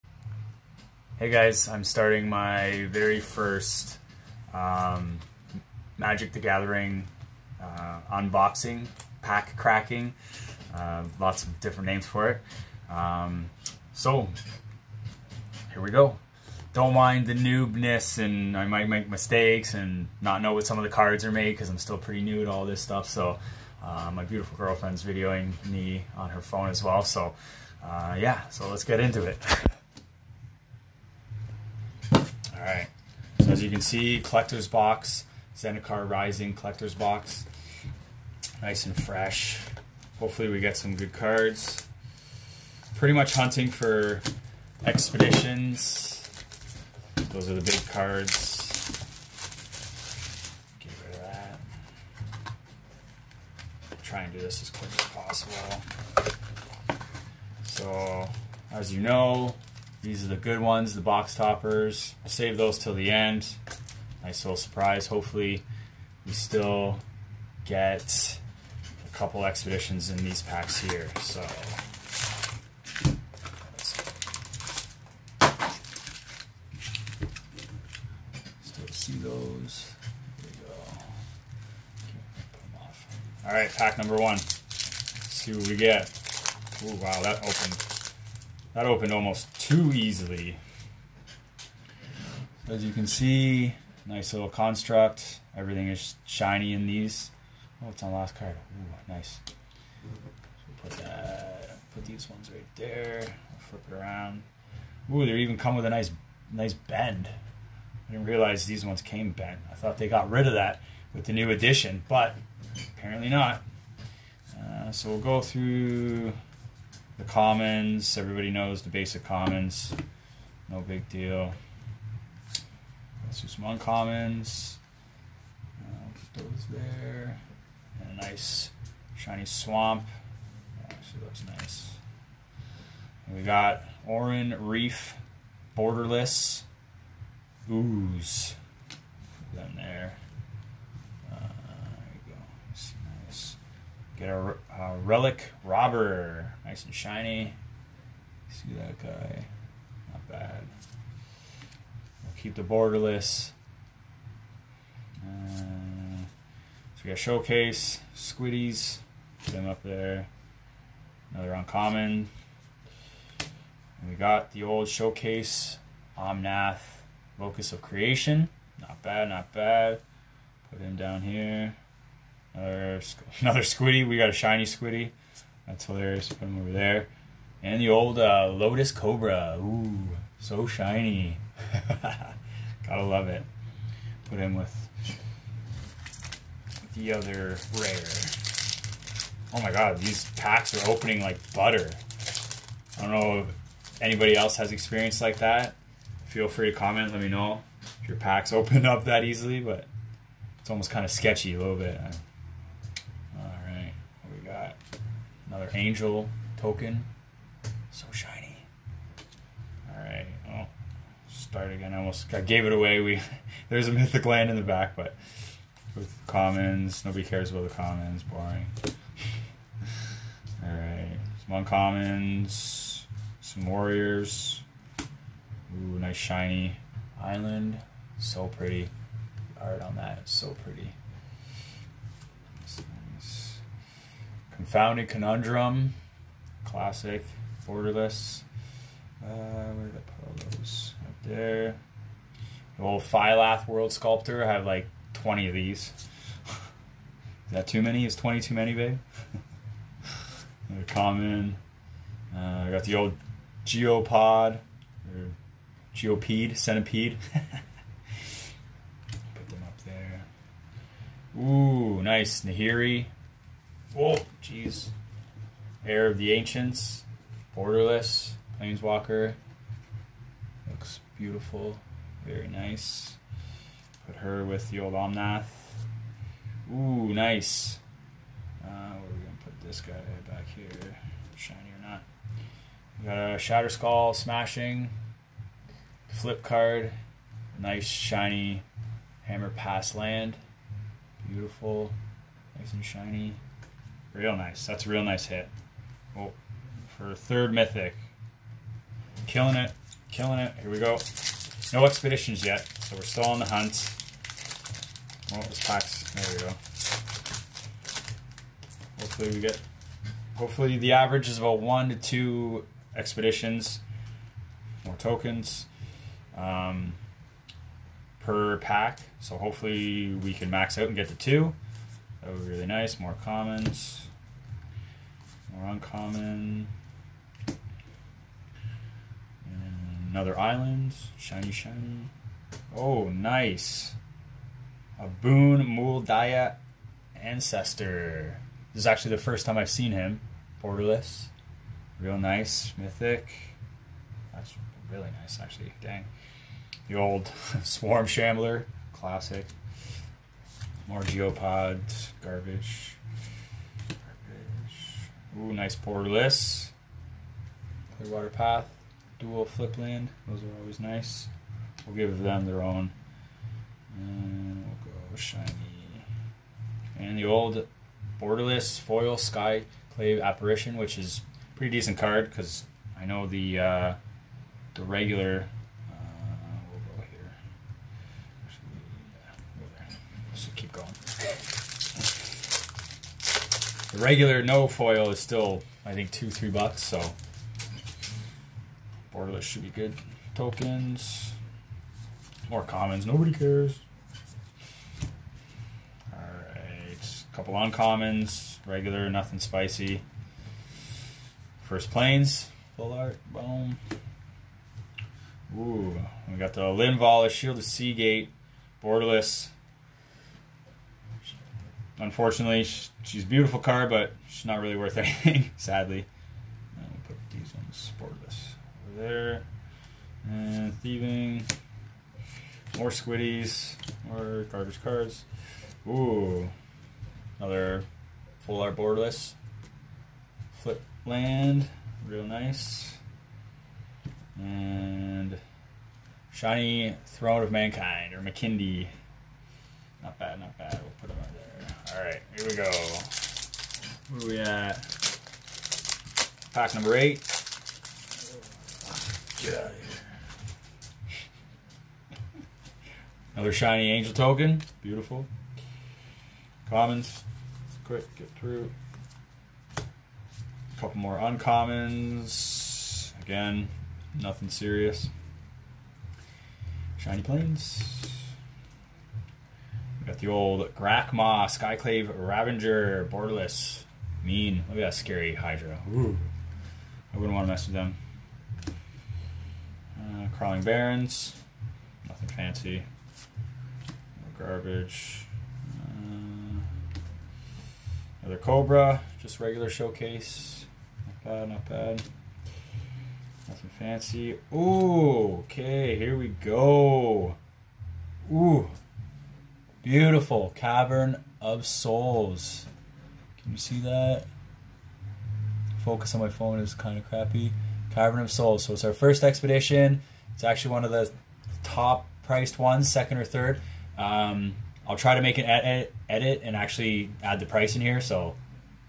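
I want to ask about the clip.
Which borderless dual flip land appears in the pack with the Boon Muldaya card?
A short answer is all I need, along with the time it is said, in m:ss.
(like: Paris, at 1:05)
Clearwater Path, at 5:57.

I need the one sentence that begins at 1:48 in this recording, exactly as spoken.
I didn't realize these ones came bent.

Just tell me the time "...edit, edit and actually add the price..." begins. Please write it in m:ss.
8:35.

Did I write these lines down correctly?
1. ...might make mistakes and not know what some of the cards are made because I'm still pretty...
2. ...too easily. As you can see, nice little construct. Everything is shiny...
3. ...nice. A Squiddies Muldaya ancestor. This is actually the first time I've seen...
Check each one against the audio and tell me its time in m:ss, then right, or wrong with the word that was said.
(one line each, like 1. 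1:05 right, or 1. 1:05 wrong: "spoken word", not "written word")
1. 0:18 right
2. 1:29 right
3. 5:33 wrong: "Boon", not "Squiddies".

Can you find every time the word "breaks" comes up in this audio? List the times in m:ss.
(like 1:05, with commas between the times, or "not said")
not said.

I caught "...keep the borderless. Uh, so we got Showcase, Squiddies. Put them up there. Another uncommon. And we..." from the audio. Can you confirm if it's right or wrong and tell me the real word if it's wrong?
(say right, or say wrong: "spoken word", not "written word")
right.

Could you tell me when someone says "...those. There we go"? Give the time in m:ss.
1:19.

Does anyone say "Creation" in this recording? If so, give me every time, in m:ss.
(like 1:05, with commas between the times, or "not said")
2:47.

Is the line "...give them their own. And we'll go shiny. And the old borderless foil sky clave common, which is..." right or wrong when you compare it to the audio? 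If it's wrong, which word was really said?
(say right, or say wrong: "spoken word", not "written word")
wrong: "apparition", not "common".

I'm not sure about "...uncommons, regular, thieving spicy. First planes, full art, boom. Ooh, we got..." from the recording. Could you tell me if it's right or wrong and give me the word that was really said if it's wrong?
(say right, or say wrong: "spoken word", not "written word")
wrong: "nothing", not "thieving".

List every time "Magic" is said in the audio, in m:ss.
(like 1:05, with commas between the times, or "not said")
0:05.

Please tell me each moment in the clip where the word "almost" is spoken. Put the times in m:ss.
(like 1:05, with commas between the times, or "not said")
1:29, 3:20, 3:31.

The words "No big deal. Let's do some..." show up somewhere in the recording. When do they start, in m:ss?
2:00.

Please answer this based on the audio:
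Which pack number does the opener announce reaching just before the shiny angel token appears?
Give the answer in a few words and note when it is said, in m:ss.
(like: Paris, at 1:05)
8, at 7:26.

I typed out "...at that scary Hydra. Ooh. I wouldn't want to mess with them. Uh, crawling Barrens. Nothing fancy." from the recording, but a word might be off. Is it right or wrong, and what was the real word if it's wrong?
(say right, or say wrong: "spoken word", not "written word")
right.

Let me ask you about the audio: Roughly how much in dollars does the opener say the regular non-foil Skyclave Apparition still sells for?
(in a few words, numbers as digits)
2-3 dollars.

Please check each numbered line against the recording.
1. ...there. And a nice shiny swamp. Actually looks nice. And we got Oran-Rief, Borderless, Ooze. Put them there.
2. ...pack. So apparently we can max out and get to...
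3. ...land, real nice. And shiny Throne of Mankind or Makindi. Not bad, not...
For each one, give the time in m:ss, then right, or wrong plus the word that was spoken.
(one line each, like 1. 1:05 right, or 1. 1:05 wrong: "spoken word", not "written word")
1. 2:06 right
2. 5:18 wrong: "hopefully", not "apparently"
3. 7:11 right.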